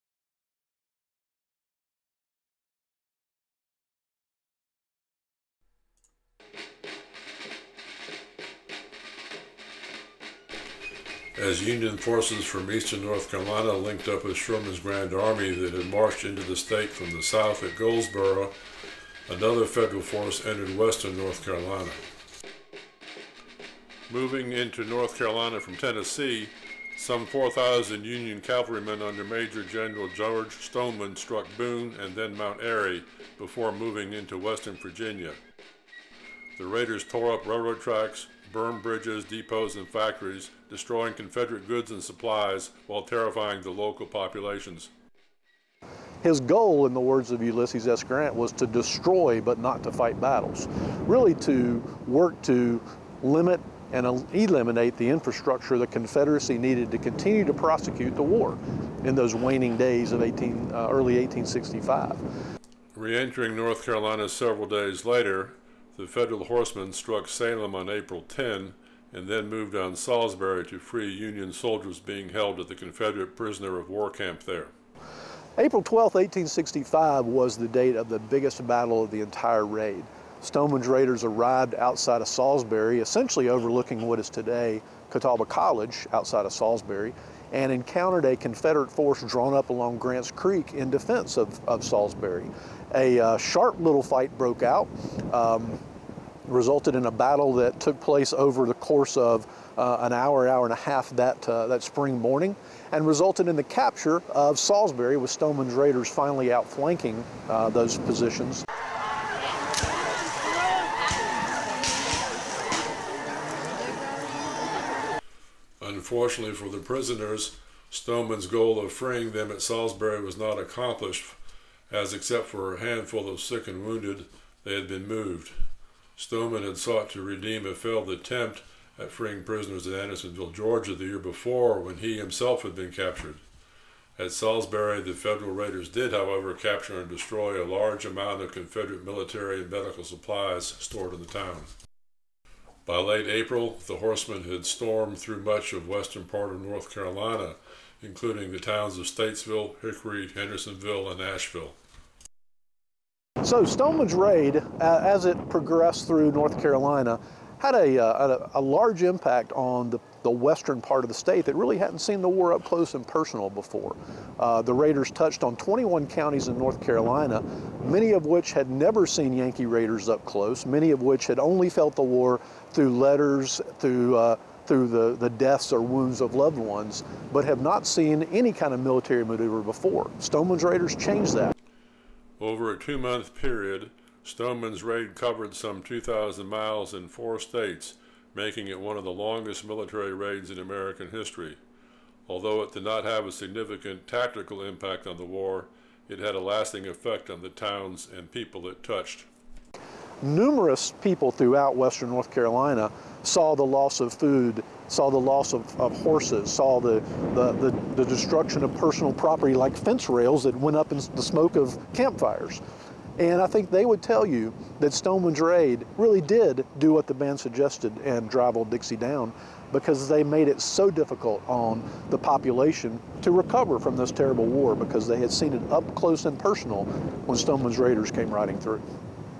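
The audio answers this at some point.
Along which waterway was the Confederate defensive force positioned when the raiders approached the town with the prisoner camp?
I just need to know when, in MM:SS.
01:29.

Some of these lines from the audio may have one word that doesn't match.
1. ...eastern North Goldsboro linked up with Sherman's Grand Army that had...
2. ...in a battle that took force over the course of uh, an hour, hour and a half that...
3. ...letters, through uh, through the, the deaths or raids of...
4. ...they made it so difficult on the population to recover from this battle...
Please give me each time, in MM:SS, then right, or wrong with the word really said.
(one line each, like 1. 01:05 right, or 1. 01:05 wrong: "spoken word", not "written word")
1. 00:12 wrong: "Carolina", not "Goldsboro"
2. 01:36 wrong: "place", not "force"
3. 02:52 wrong: "wounds", not "raids"
4. 03:40 wrong: "terrible", not "battle".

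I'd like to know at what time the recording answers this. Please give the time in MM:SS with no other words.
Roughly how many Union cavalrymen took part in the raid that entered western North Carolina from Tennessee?
00:27.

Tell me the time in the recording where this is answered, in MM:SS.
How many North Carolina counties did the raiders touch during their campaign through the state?
02:45.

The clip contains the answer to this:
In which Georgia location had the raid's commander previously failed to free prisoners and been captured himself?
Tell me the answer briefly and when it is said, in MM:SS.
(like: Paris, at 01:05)
Andersonville, at 02:09.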